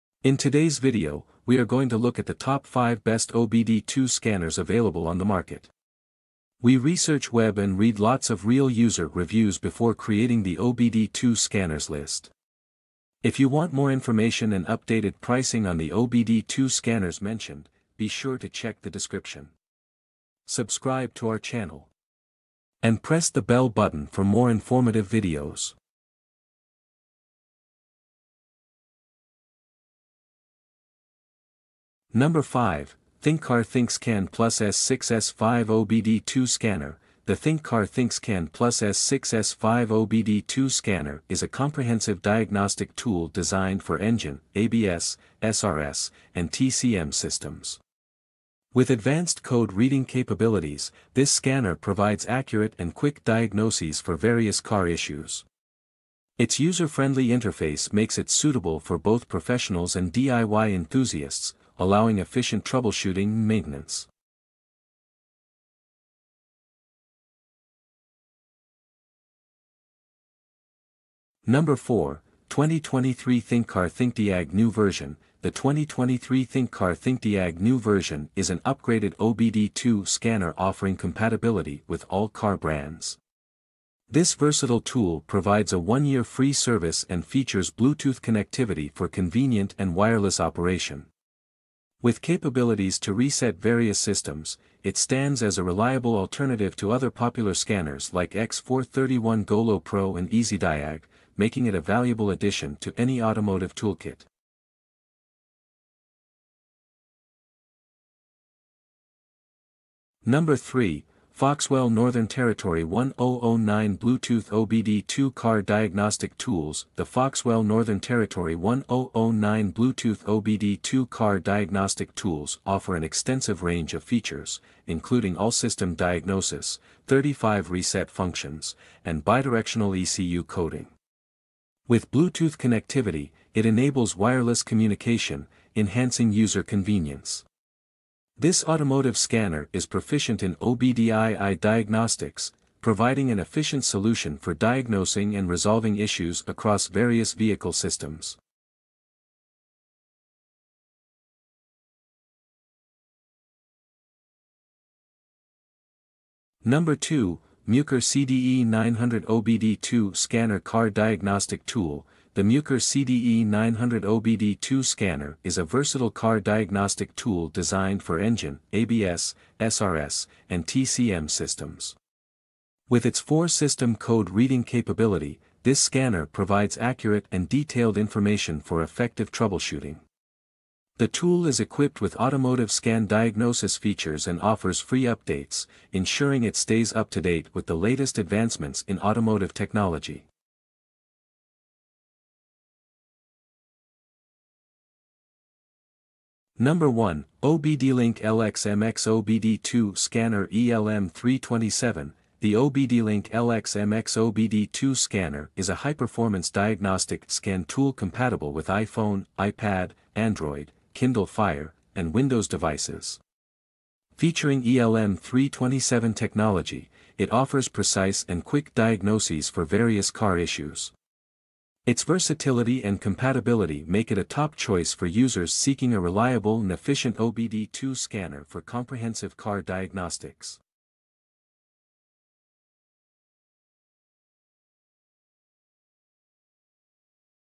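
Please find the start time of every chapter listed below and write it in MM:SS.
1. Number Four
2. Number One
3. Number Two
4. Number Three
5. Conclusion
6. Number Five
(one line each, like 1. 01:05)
1. 01:05
2. 03:10
3. 02:31
4. 01:44
5. 03:49
6. 00:26.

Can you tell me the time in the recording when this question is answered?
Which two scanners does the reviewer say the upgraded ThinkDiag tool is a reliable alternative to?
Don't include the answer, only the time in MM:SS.
01:38.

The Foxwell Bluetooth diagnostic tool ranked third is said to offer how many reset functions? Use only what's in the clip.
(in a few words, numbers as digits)
35.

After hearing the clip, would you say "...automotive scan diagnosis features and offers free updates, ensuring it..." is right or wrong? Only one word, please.
right.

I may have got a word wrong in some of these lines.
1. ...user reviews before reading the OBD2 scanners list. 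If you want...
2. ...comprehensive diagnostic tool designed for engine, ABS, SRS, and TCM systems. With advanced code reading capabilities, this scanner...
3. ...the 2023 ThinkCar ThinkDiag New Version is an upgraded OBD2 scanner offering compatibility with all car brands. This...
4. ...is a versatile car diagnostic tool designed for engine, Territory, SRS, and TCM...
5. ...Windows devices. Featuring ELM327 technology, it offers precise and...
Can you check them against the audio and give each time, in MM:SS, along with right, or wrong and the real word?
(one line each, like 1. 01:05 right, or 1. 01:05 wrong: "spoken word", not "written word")
1. 00:08 wrong: "creating", not "reading"
2. 00:41 right
3. 01:15 right
4. 02:45 wrong: "ABS", not "Territory"
5. 03:32 right.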